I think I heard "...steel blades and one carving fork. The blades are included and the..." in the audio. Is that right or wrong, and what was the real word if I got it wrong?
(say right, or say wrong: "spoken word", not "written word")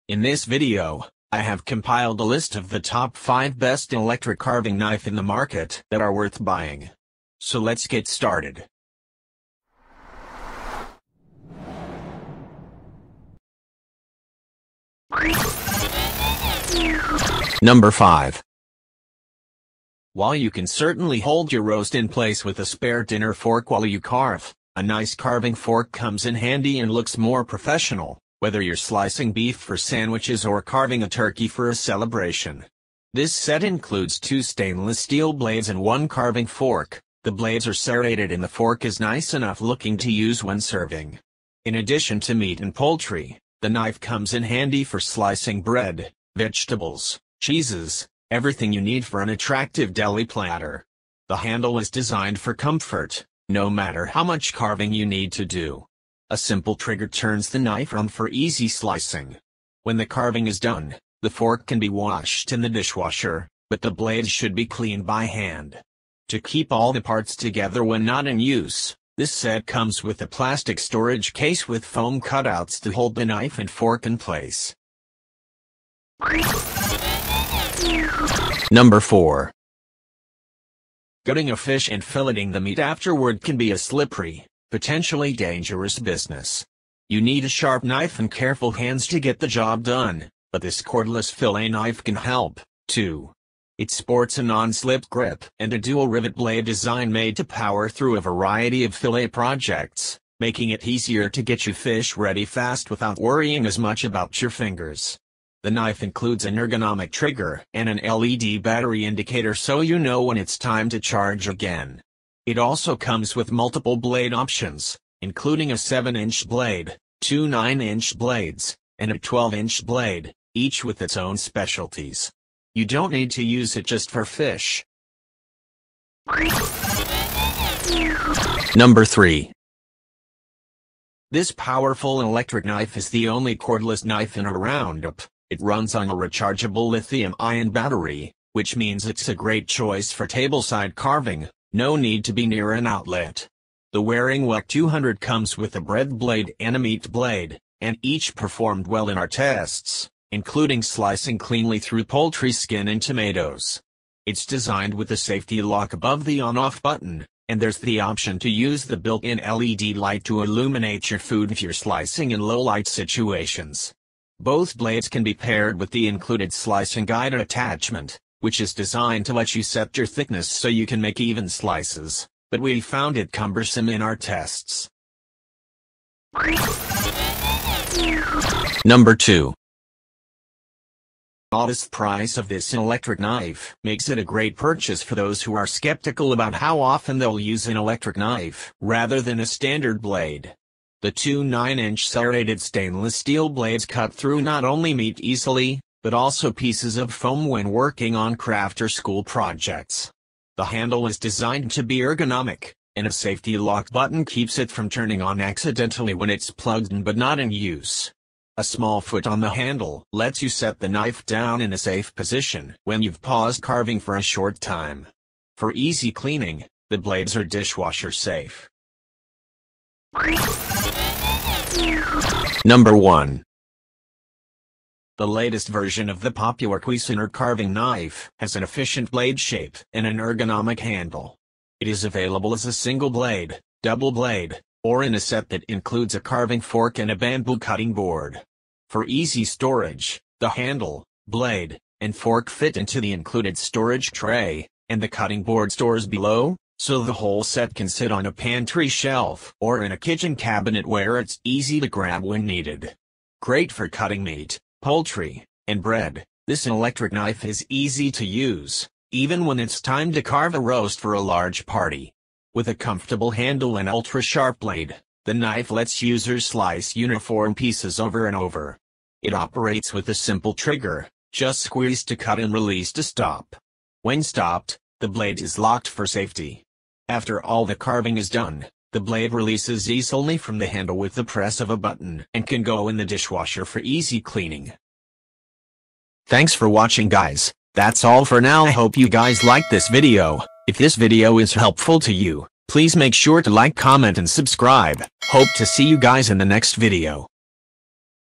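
wrong: "serrated", not "included".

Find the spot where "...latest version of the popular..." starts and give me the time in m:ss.
3:45.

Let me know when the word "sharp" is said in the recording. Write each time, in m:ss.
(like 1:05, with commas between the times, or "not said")
1:27, 4:23.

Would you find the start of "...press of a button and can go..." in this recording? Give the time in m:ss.
4:41.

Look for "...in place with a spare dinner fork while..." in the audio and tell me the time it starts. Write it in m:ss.
0:21.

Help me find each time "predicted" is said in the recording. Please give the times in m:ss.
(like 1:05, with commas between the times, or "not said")
not said.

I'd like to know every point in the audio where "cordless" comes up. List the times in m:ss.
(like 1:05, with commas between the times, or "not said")
1:30, 2:13.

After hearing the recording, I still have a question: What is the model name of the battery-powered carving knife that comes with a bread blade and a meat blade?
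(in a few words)
Waring WEC 200.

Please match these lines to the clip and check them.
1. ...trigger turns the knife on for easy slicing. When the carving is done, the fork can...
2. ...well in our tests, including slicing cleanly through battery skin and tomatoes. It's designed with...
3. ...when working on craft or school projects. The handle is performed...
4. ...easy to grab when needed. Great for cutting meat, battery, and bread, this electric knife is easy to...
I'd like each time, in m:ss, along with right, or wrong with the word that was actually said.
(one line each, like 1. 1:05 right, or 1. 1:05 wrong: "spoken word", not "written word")
1. 0:56 right
2. 2:28 wrong: "poultry", not "battery"
3. 3:17 wrong: "designed", not "performed"
4. 4:11 wrong: "poultry", not "battery".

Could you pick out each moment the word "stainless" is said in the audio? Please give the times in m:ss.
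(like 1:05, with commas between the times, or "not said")
0:34, 3:12.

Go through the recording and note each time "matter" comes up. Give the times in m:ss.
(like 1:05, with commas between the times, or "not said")
0:53.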